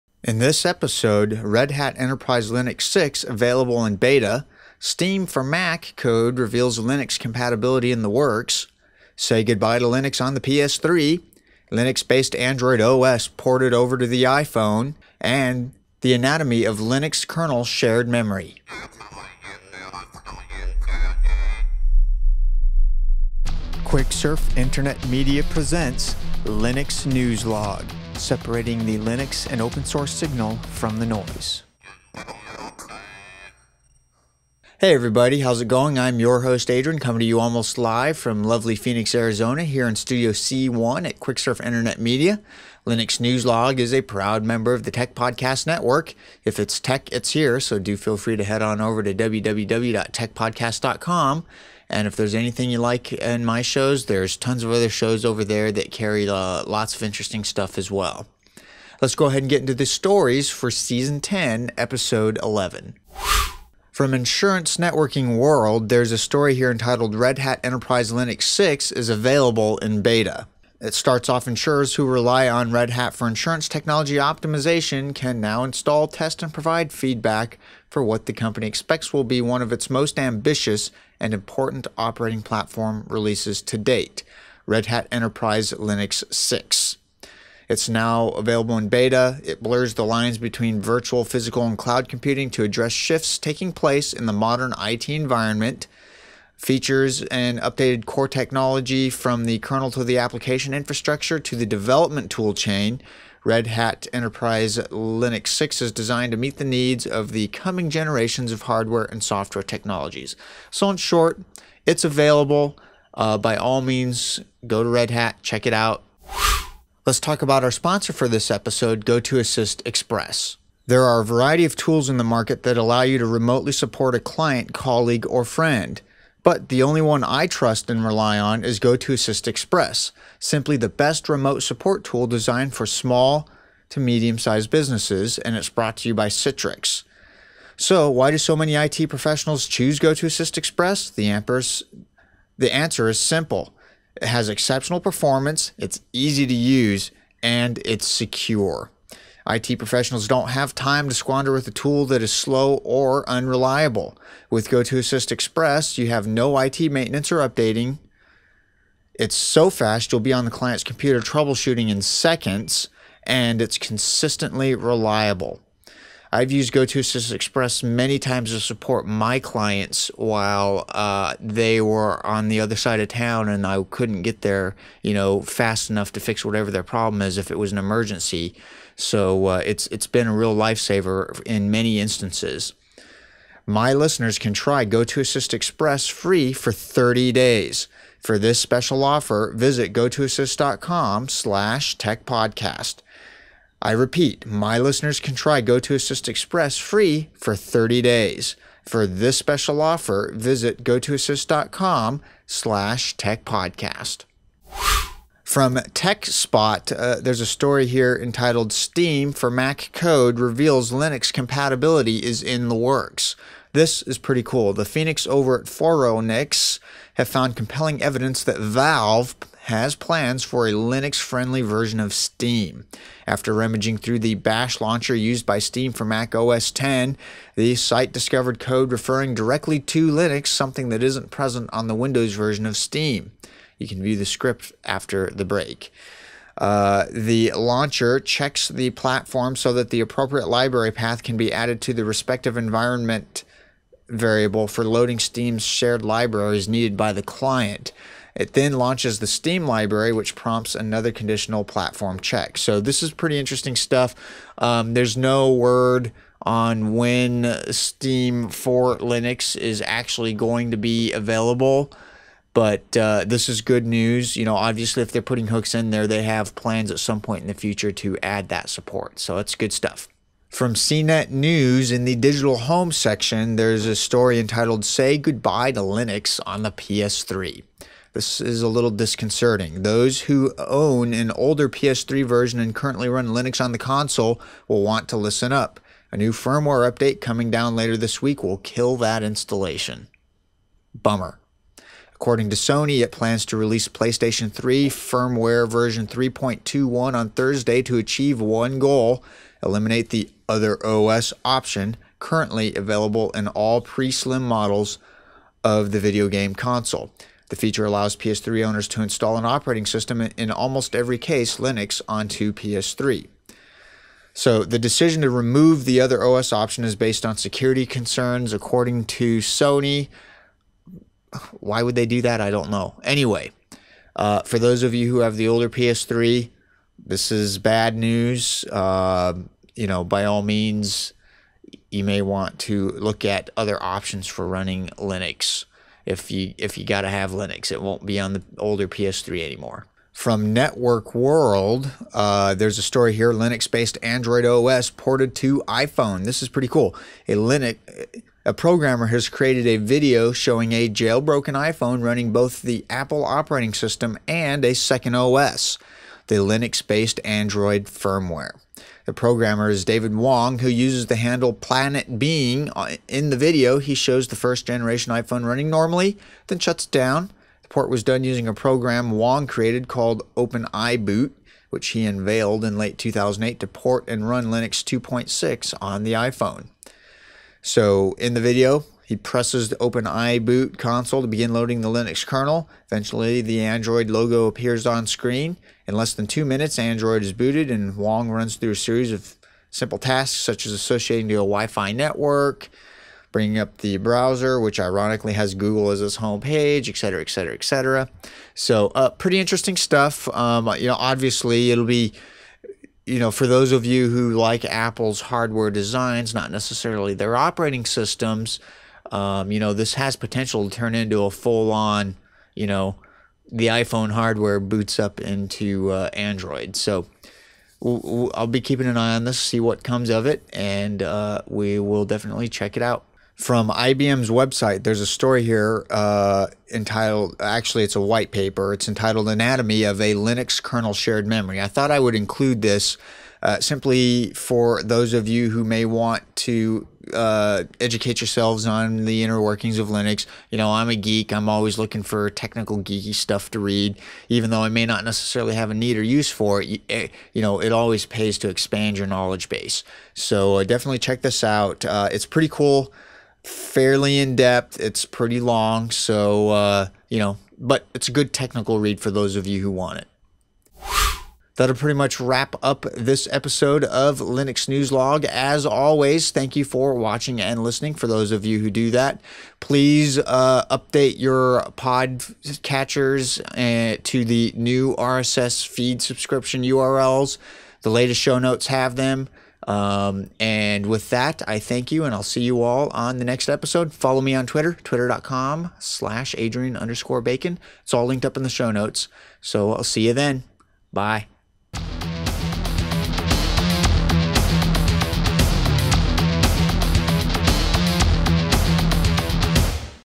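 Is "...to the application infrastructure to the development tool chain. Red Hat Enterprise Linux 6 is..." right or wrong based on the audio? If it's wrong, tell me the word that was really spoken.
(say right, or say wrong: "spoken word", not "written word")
right.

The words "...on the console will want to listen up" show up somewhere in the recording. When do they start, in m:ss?
4:43.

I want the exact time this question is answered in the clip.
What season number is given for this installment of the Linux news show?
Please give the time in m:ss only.
1:00.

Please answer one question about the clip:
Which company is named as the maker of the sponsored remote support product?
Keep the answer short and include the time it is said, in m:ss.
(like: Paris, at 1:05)
Citrix, at 2:16.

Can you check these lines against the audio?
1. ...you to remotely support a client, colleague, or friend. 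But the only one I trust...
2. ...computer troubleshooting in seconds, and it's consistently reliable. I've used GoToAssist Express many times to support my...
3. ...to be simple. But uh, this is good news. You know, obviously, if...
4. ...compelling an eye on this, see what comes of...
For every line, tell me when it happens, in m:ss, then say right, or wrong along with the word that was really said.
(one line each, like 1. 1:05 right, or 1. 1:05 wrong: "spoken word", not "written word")
1. 2:03 right
2. 2:40 right
3. 4:20 wrong: "available", not "simple"
4. 6:58 wrong: "keeping", not "compelling".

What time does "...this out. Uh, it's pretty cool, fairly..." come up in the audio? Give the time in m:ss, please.
7:31.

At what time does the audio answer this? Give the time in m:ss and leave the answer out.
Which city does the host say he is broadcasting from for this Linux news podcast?
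0:38.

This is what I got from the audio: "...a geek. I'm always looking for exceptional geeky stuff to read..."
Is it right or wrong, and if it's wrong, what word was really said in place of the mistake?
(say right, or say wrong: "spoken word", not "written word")
wrong: "technical", not "exceptional".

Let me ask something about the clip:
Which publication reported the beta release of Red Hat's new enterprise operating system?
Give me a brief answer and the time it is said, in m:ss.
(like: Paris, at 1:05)
Insurance Networking World, at 1:04.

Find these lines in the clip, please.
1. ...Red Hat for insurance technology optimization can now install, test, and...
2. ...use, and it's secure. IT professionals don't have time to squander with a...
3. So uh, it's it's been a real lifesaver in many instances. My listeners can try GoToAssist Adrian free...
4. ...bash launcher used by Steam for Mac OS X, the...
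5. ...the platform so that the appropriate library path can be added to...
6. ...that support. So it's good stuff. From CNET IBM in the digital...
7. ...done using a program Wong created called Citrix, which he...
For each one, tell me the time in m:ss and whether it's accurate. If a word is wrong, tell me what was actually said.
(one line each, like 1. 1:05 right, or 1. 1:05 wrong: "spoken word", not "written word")
1. 1:12 right
2. 2:26 right
3. 2:58 wrong: "Express", not "Adrian"
4. 3:44 right
5. 3:58 right
6. 4:28 wrong: "News", not "IBM"
7. 6:08 wrong: "OpenIBoot", not "Citrix".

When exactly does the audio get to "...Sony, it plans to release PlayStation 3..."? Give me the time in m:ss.
4:52.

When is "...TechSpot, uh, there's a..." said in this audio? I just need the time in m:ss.
3:25.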